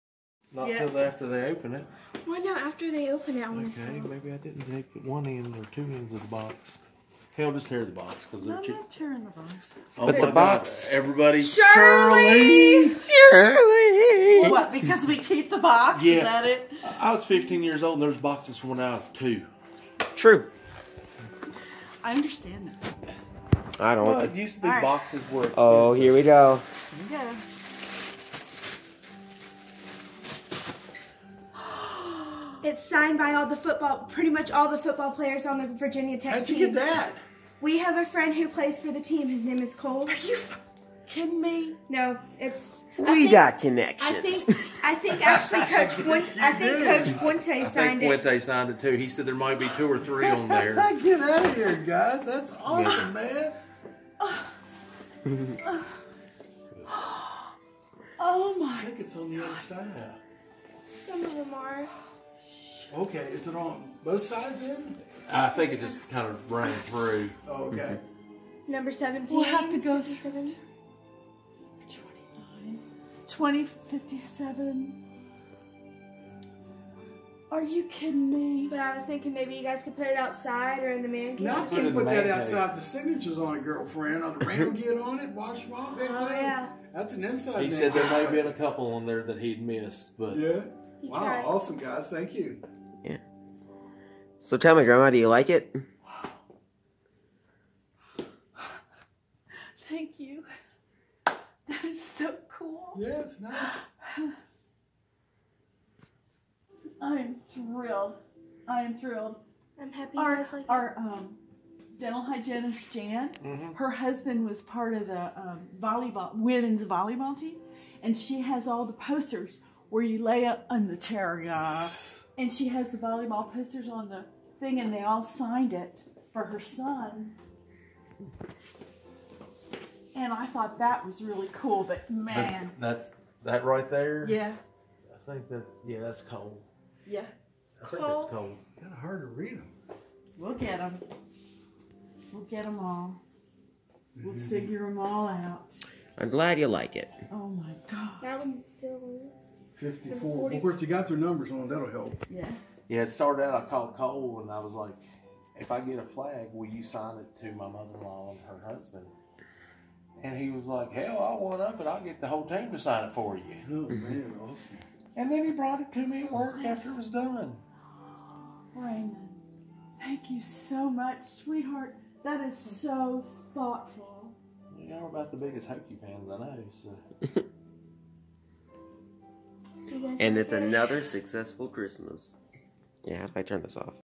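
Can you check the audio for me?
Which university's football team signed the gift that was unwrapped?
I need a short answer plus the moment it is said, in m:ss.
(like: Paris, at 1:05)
Virginia Tech, at 0:35.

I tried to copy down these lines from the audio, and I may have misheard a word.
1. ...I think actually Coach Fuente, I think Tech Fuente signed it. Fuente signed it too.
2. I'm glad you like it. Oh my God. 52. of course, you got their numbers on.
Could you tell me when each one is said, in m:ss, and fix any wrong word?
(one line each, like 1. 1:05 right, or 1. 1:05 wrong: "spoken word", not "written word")
1. 0:44 wrong: "Coach", not "Tech"
2. 2:26 wrong: "54", not "52".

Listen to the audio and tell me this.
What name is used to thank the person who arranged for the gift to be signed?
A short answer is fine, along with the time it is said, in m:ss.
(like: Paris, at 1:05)
Raymond, at 2:48.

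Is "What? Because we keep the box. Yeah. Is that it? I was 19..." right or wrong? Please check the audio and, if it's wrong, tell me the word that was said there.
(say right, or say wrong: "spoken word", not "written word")
wrong: "15", not "19".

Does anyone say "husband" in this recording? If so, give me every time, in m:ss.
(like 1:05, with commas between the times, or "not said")
1:53, 2:38.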